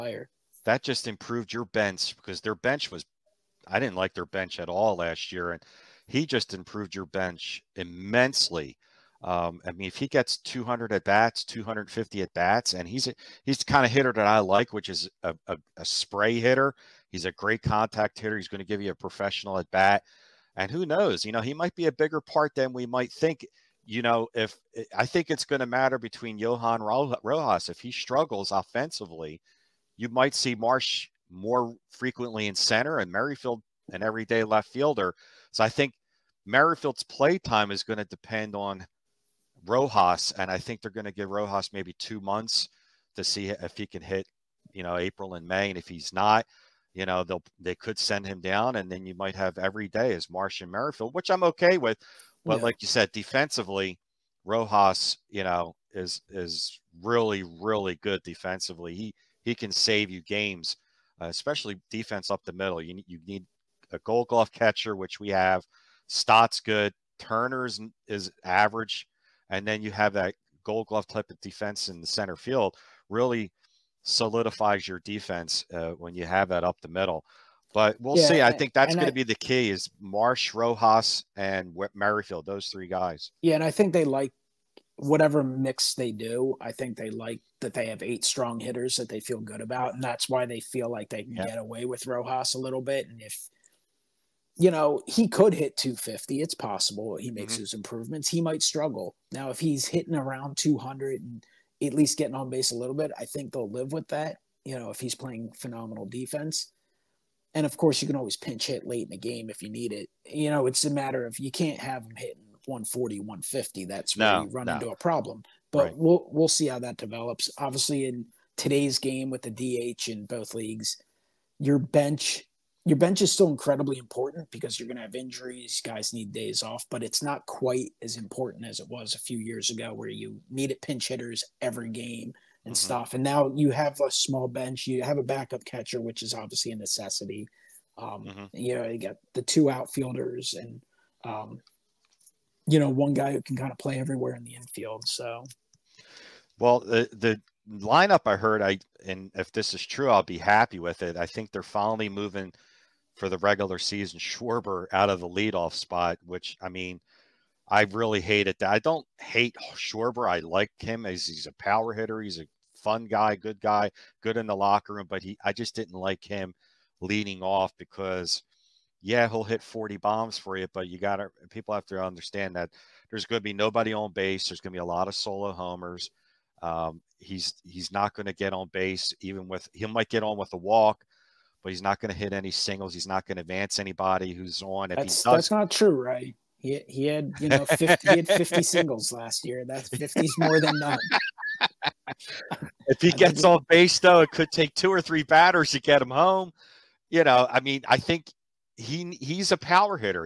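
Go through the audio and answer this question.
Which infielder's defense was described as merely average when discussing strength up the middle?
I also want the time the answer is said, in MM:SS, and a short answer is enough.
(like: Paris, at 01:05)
Turner, at 01:07.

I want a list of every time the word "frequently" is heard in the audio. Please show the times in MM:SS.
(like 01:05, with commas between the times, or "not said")
00:31.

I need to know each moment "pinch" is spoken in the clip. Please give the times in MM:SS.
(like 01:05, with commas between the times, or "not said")
01:48, 02:10.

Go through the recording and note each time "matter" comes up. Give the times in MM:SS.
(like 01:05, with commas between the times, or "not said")
00:25, 01:50.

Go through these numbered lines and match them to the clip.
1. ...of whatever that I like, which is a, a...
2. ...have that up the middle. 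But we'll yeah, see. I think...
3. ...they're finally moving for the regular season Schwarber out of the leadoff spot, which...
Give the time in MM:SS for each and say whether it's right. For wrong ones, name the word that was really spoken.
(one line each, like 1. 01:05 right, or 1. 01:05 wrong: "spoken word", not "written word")
1. 00:13 wrong: "hitter", not "whatever"
2. 01:16 right
3. 02:31 right.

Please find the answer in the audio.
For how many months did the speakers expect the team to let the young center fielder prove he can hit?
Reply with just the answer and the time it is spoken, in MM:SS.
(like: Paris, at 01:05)
2, at 00:41.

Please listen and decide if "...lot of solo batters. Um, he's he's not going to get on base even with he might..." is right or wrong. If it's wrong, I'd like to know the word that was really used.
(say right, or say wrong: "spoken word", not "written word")
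wrong: "homers", not "batters".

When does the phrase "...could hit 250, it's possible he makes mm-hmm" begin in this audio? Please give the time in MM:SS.
01:35.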